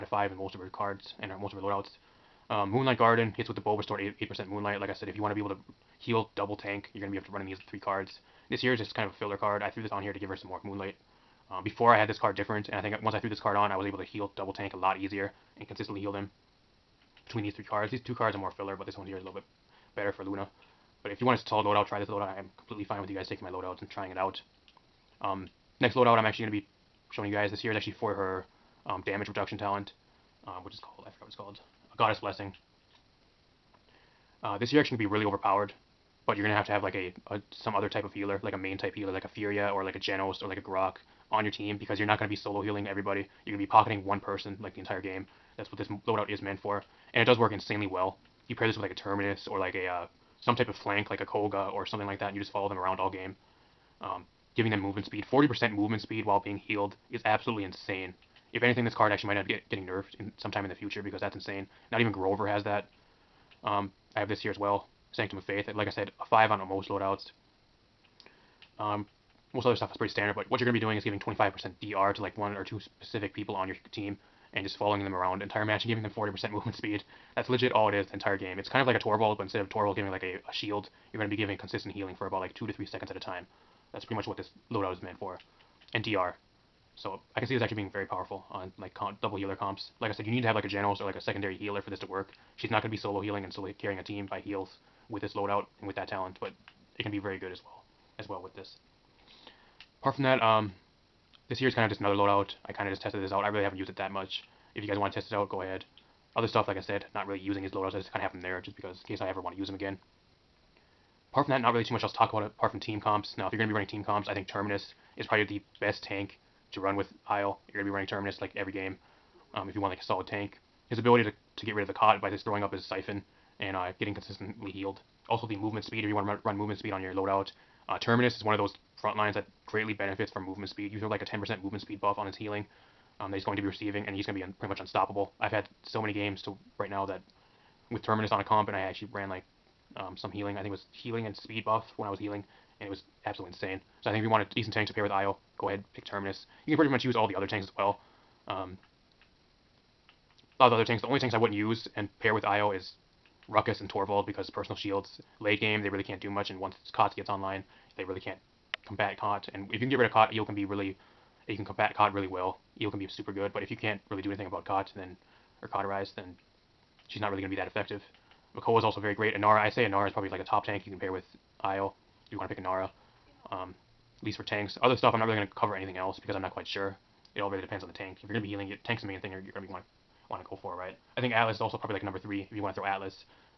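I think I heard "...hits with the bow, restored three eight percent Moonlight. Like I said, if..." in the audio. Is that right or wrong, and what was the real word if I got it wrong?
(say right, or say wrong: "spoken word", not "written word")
wrong: "eight", not "three".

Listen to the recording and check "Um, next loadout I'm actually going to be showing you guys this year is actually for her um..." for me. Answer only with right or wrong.
right.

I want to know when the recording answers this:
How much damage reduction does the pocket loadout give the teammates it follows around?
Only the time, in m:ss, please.
1:11.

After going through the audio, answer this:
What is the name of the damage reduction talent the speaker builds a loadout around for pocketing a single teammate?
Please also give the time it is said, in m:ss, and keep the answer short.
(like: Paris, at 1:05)
Goddess Blessing, at 0:31.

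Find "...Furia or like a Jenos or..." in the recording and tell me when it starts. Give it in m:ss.
0:39.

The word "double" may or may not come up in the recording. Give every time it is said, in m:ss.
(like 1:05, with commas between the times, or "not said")
0:06, 0:14, 1:29.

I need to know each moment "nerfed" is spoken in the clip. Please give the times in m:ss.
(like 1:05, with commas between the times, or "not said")
0:59.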